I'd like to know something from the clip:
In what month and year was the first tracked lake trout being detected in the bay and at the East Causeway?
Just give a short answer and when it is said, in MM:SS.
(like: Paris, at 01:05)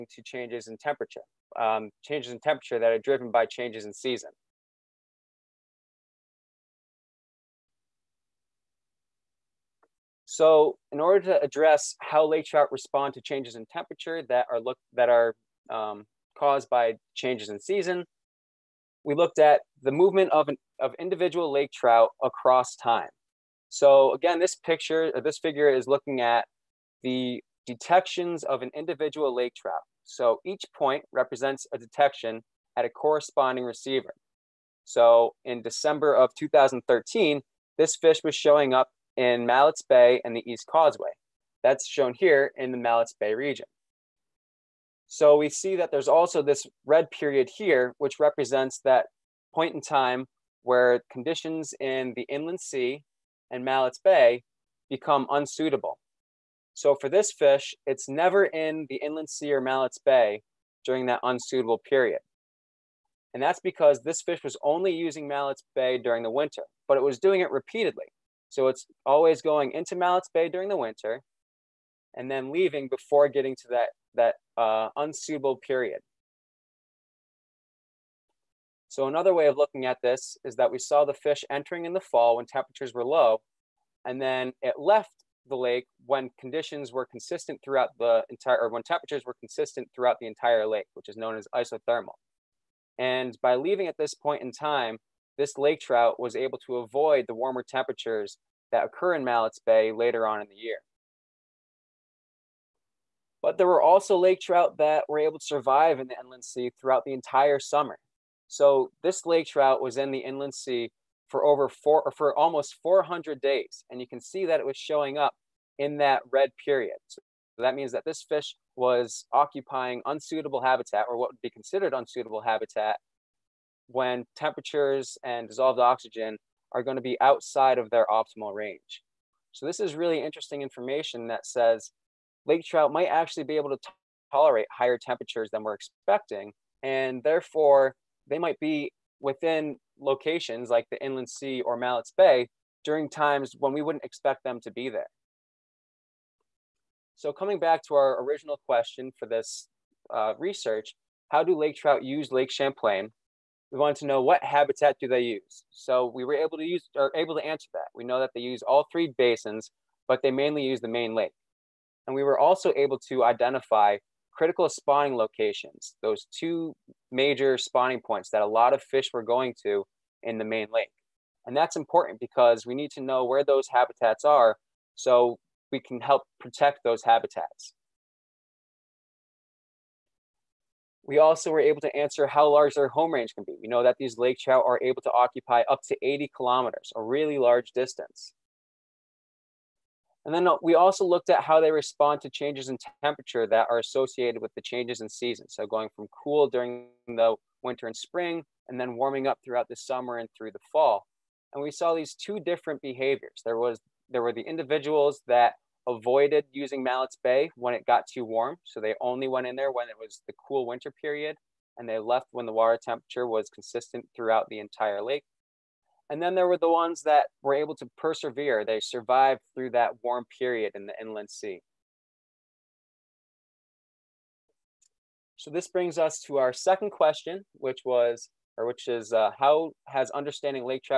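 December 2013, at 00:35.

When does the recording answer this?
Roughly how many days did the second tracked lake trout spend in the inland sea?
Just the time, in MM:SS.
01:52.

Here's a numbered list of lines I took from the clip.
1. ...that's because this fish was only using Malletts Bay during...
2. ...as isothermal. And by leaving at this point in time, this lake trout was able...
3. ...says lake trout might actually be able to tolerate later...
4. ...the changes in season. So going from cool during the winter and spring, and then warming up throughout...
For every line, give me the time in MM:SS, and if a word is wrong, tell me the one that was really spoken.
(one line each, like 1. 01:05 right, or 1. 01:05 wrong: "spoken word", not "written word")
1. 01:03 right
2. 01:31 right
3. 02:11 wrong: "higher", not "later"
4. 03:14 right.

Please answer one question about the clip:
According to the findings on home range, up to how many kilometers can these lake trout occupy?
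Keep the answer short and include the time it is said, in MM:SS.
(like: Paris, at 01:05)
80 kilometers, at 03:06.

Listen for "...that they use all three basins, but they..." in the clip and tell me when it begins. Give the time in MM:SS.
02:38.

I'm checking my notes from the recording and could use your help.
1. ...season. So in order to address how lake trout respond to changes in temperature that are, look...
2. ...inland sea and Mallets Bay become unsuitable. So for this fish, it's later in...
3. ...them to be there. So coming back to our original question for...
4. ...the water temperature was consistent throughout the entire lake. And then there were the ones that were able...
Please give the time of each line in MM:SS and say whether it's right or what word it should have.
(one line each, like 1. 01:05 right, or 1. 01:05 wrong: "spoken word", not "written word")
1. 00:03 right
2. 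00:52 wrong: "never", not "later"
3. 02:24 right
4. 03:32 right.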